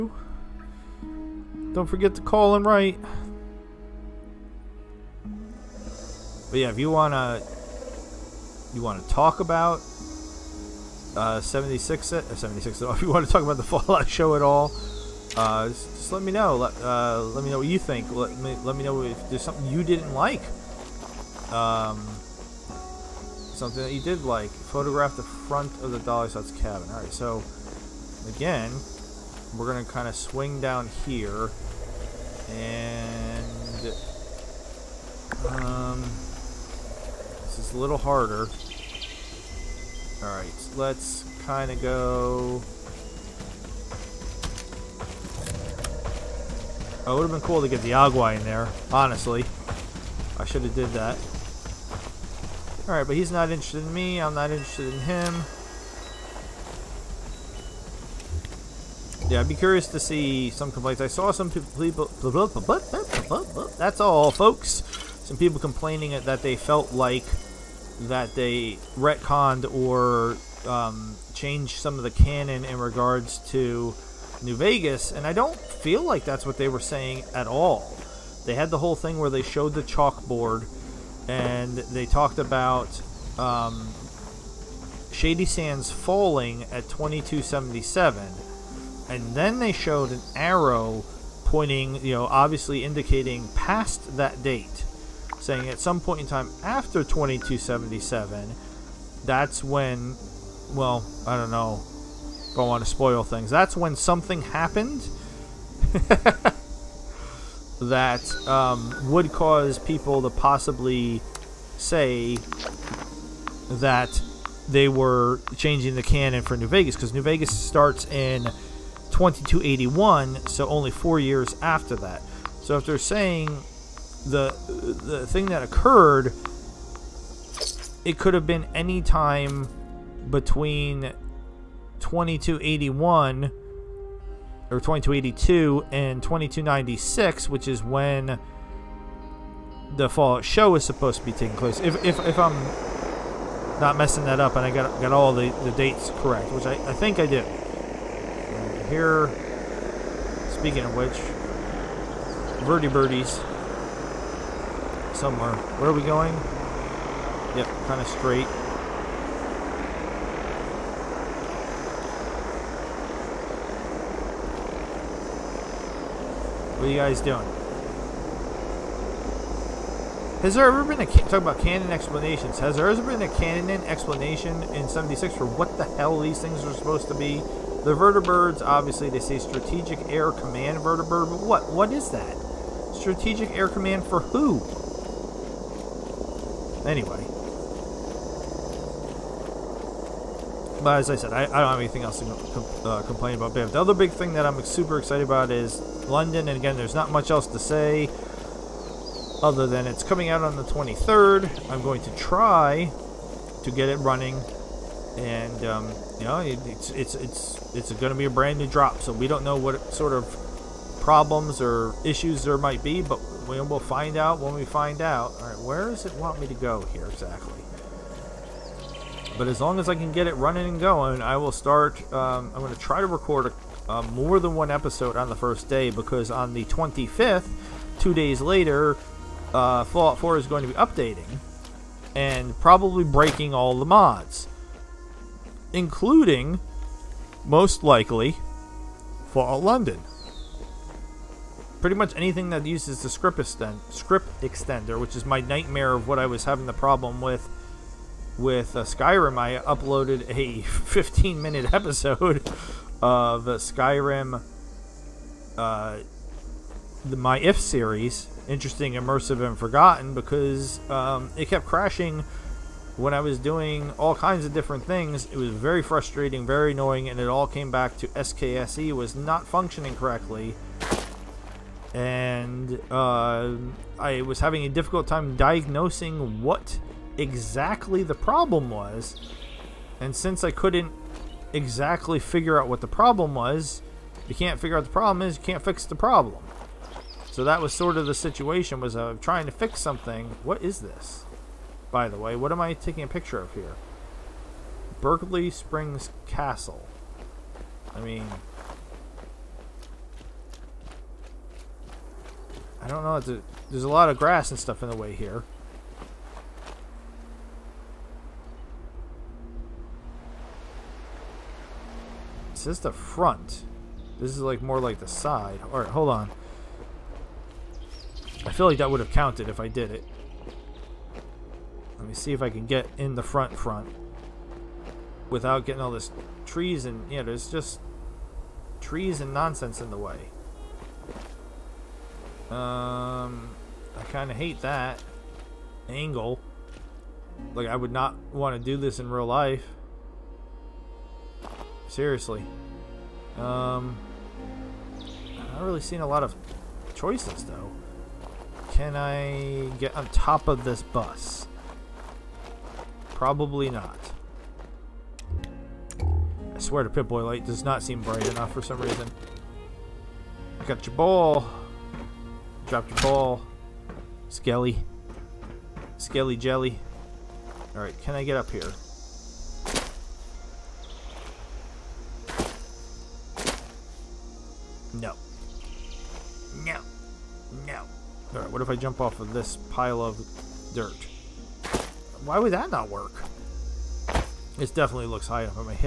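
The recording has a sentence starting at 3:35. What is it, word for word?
All right, where does it want me to go here exactly?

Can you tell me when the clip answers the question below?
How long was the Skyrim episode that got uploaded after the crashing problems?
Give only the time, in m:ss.
4:10.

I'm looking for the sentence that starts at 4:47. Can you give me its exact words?
So that was sort of the situation was uh, trying to fix something.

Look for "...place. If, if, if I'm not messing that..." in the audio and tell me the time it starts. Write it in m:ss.
2:21.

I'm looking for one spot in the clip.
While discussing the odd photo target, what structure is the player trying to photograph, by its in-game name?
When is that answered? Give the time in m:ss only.
4:55.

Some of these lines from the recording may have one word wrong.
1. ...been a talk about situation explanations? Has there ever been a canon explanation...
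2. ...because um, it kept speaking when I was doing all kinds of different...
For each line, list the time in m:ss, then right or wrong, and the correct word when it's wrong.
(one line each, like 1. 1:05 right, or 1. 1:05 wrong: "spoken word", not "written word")
1. 2:50 wrong: "canon", not "situation"
2. 4:20 wrong: "crashing", not "speaking".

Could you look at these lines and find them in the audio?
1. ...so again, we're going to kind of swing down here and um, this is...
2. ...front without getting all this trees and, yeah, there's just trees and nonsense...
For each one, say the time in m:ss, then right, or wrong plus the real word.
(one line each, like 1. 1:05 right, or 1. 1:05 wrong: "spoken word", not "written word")
1. 0:27 right
2. 5:23 right.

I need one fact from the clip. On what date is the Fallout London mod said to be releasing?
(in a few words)
the 23rd.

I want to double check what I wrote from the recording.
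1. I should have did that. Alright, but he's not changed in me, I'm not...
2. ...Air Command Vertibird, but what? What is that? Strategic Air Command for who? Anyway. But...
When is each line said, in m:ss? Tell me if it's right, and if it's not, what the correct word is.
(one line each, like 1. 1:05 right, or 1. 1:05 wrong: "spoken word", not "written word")
1. 0:50 wrong: "interested", not "changed"
2. 3:00 right.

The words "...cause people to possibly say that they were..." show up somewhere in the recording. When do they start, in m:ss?
1:49.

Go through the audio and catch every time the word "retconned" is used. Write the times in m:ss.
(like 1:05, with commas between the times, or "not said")
1:08.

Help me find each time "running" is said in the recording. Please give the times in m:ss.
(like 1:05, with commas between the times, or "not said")
3:23, 3:40.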